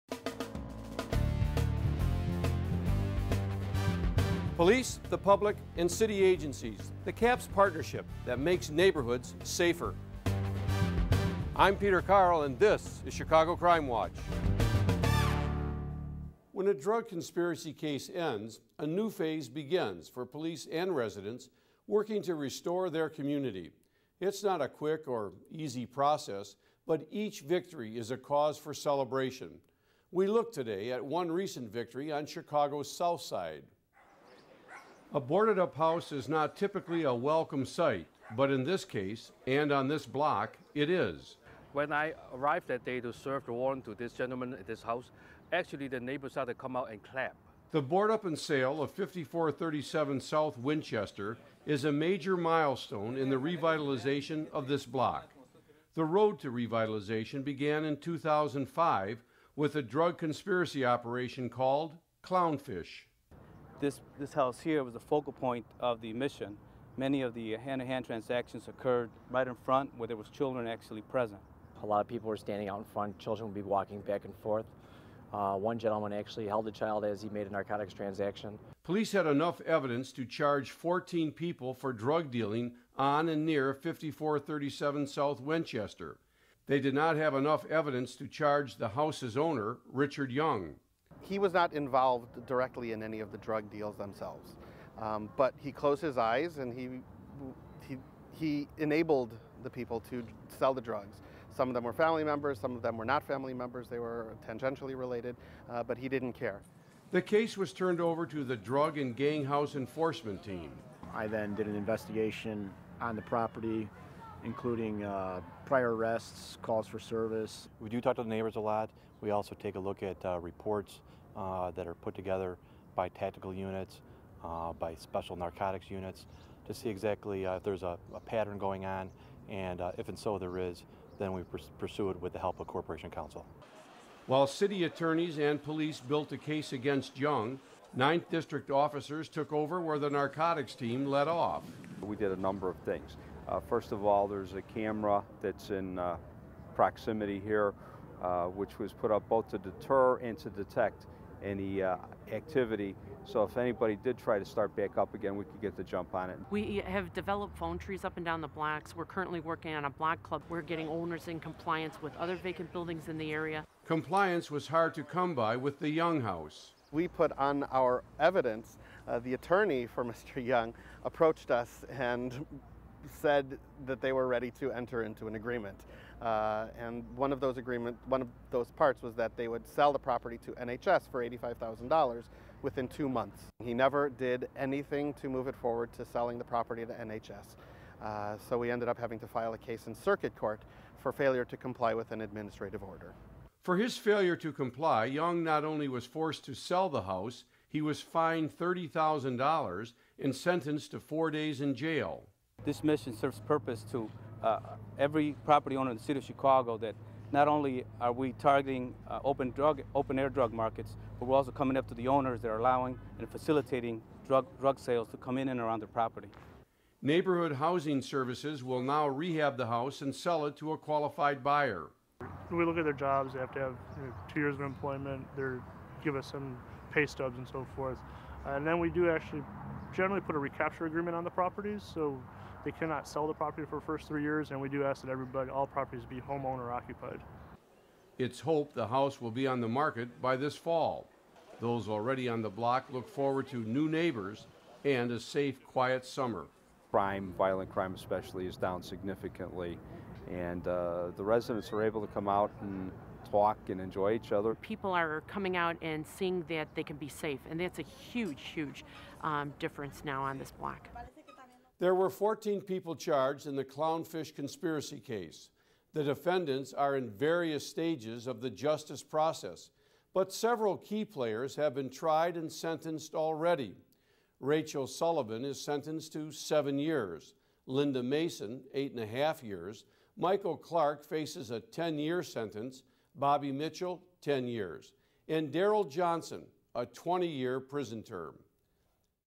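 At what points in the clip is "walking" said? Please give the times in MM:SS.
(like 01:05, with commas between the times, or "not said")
01:13.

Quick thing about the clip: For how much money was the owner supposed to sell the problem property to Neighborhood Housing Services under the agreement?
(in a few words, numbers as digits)
$85,000.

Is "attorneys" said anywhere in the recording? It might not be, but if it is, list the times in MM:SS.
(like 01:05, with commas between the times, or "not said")
02:14, 02:49.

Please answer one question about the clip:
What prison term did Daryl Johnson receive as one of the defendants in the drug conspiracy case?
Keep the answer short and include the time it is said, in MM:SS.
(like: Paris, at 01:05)
20 years, at 04:46.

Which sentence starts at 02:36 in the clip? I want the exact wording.
We have developed phone trees up and down the blocks.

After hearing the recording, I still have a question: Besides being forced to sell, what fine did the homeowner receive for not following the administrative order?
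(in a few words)
$30,000.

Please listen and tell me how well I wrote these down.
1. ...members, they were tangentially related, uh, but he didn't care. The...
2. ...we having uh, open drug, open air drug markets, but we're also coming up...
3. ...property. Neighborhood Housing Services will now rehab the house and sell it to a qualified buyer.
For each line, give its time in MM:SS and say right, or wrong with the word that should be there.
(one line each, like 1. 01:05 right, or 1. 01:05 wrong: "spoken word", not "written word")
1. 01:43 right
2. 03:28 wrong: "targeting", not "having"
3. 03:35 right.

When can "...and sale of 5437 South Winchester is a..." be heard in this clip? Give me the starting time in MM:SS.
00:48.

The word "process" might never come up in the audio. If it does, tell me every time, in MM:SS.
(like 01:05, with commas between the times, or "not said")
00:25, 04:29.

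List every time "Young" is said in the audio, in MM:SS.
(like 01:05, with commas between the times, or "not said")
01:30, 02:17, 02:45, 02:50, 03:15.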